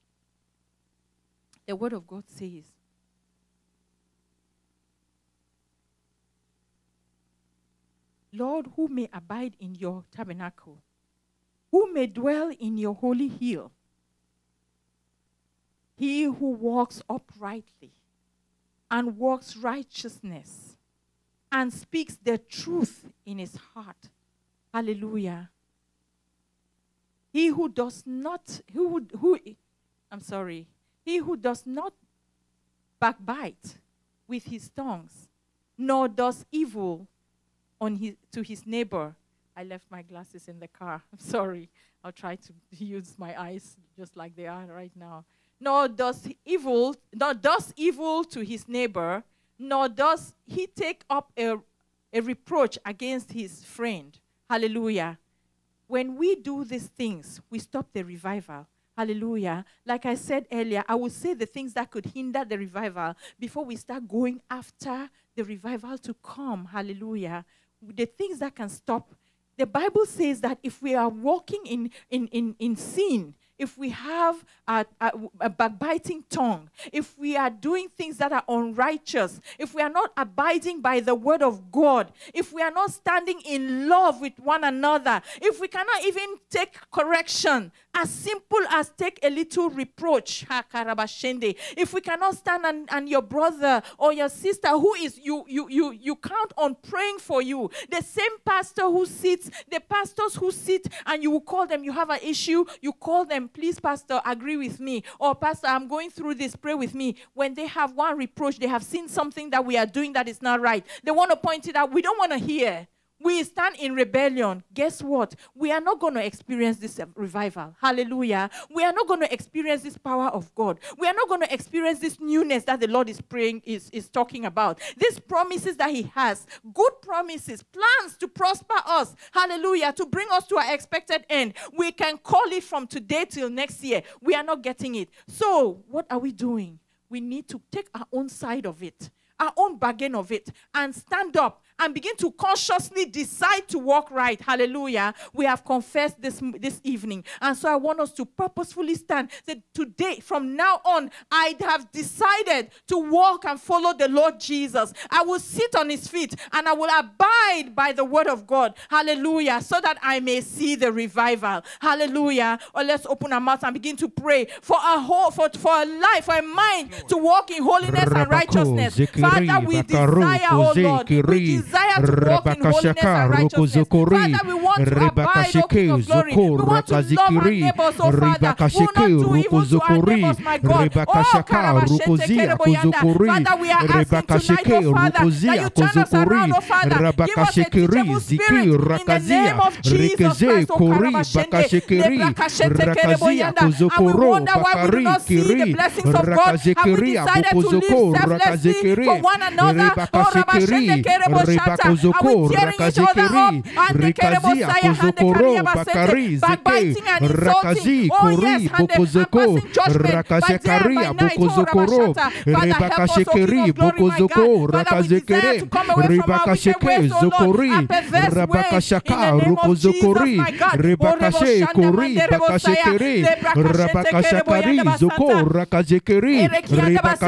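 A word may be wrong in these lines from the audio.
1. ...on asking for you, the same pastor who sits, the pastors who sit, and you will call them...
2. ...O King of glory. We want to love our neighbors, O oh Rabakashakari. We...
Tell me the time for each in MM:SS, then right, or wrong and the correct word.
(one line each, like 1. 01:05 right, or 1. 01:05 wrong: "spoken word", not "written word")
1. 01:36 wrong: "praying", not "asking"
2. 02:55 wrong: "Father", not "Rabakashakari".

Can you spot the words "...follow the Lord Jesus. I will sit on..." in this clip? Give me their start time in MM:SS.
02:33.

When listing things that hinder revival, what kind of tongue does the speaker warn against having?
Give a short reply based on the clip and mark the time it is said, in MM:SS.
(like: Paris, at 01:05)
backbiting tongue, at 01:15.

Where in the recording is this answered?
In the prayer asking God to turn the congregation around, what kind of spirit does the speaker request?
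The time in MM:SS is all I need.
03:07.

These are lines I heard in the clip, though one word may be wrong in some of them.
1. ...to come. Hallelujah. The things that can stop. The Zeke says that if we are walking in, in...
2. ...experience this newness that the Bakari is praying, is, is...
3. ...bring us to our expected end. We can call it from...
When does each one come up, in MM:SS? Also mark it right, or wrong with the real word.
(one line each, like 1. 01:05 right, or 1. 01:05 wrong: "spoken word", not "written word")
1. 01:05 wrong: "Bible", not "Zeke"
2. 02:01 wrong: "Lord", not "Bakari"
3. 02:10 right.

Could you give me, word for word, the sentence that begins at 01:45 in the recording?
Or, Pastor, I'm going through this, pray with me.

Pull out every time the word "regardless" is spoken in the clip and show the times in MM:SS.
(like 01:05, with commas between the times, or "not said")
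not said.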